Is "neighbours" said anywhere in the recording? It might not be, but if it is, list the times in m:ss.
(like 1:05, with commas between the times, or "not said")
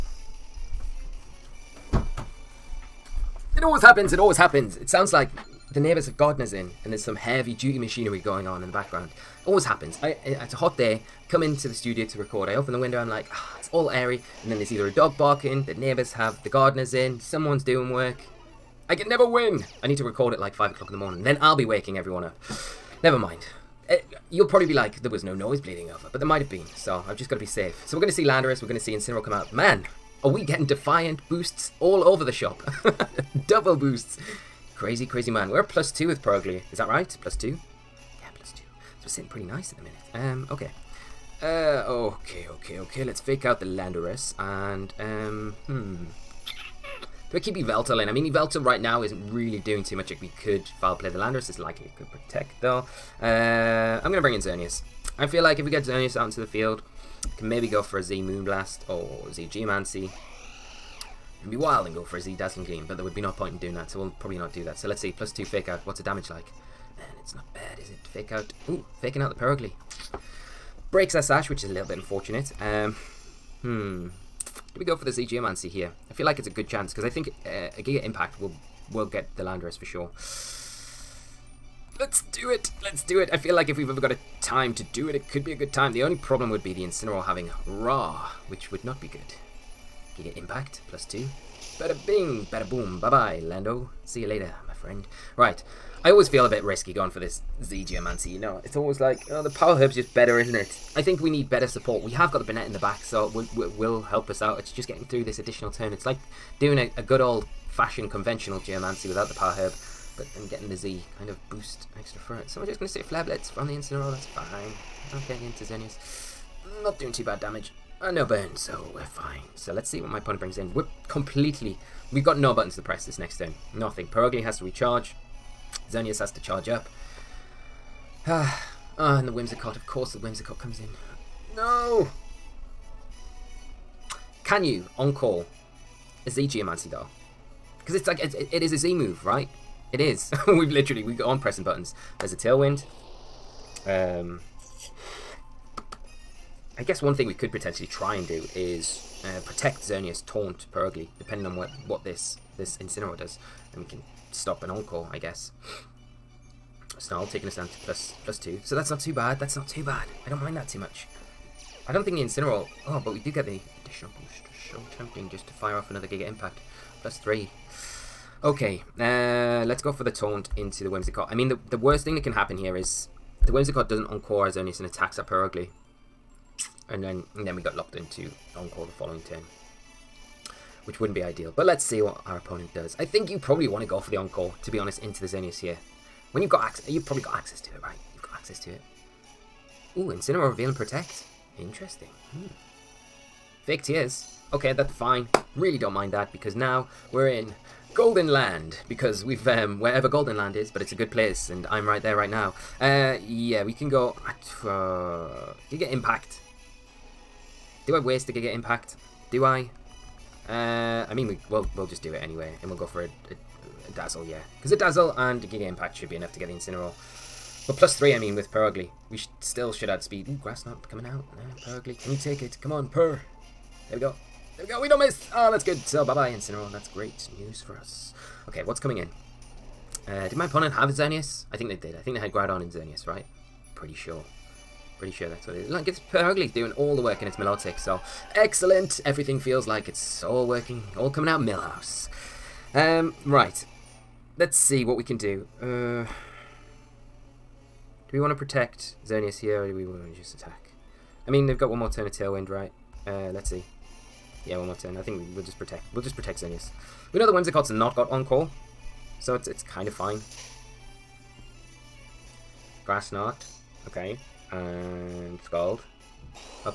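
0:05, 0:15.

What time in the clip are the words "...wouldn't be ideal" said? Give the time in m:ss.
3:00.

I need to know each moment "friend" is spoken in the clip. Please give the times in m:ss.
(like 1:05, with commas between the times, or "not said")
1:34.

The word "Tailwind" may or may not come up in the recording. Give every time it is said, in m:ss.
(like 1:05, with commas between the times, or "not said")
2:22, 4:12.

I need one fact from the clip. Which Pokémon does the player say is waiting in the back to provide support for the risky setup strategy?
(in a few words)
Banette.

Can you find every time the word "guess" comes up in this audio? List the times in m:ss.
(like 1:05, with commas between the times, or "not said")
2:26, 2:35.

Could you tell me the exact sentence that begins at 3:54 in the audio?
Pretty sure that's what it is.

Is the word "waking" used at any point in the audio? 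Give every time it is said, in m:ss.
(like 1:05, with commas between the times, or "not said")
0:21.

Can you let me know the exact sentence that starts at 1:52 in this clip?
So we're just going to say Flare Blitz from the Incineroar, that's fine.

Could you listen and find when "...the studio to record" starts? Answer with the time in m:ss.
0:11.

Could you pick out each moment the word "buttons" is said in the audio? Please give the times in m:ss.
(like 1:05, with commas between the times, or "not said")
2:02, 2:21.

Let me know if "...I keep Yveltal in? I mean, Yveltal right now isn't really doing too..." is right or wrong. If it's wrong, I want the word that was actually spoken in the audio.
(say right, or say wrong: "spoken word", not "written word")
right.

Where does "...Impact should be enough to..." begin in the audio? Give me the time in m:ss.
3:35.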